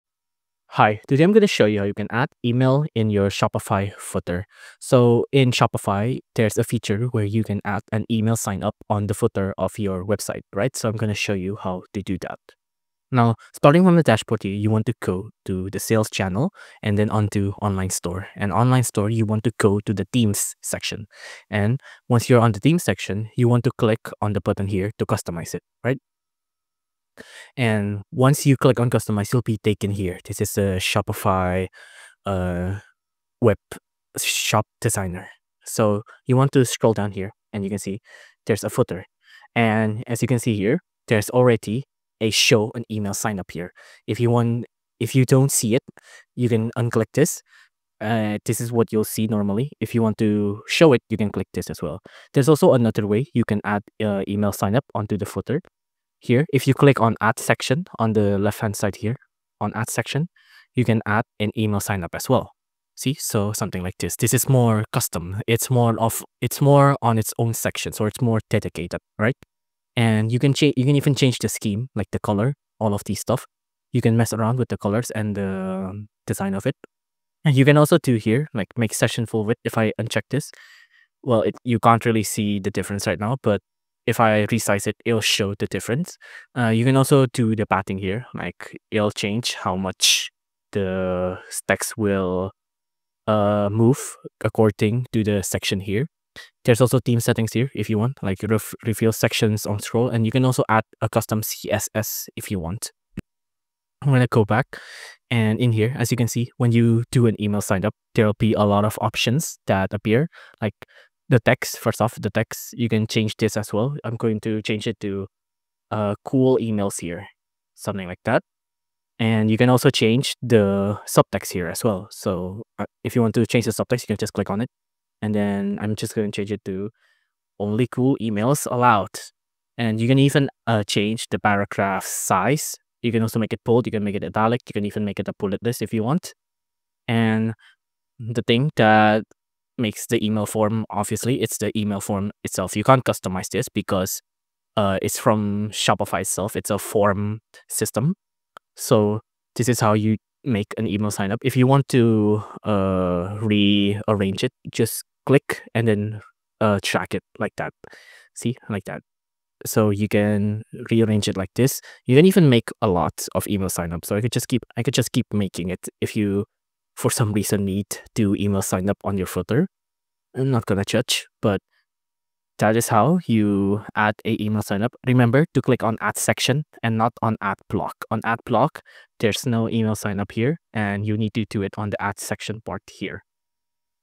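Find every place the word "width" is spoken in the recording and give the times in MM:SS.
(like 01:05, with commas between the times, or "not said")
01:19.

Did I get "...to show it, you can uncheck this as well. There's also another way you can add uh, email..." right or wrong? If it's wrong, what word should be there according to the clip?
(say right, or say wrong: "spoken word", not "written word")
wrong: "click", not "uncheck".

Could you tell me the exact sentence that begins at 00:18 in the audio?
And online store, you want to go to the themes section.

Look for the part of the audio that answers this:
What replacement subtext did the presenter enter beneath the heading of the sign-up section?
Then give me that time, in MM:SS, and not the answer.
02:07.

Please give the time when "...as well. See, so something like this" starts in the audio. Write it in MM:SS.
01:02.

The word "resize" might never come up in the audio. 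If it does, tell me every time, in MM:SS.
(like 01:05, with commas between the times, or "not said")
01:24.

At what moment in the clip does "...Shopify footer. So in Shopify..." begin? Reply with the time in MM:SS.
00:03.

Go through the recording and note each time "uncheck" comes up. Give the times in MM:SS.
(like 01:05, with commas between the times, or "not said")
01:19.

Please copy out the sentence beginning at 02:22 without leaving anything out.
You can't customize this because uh, it's from Shopify itself.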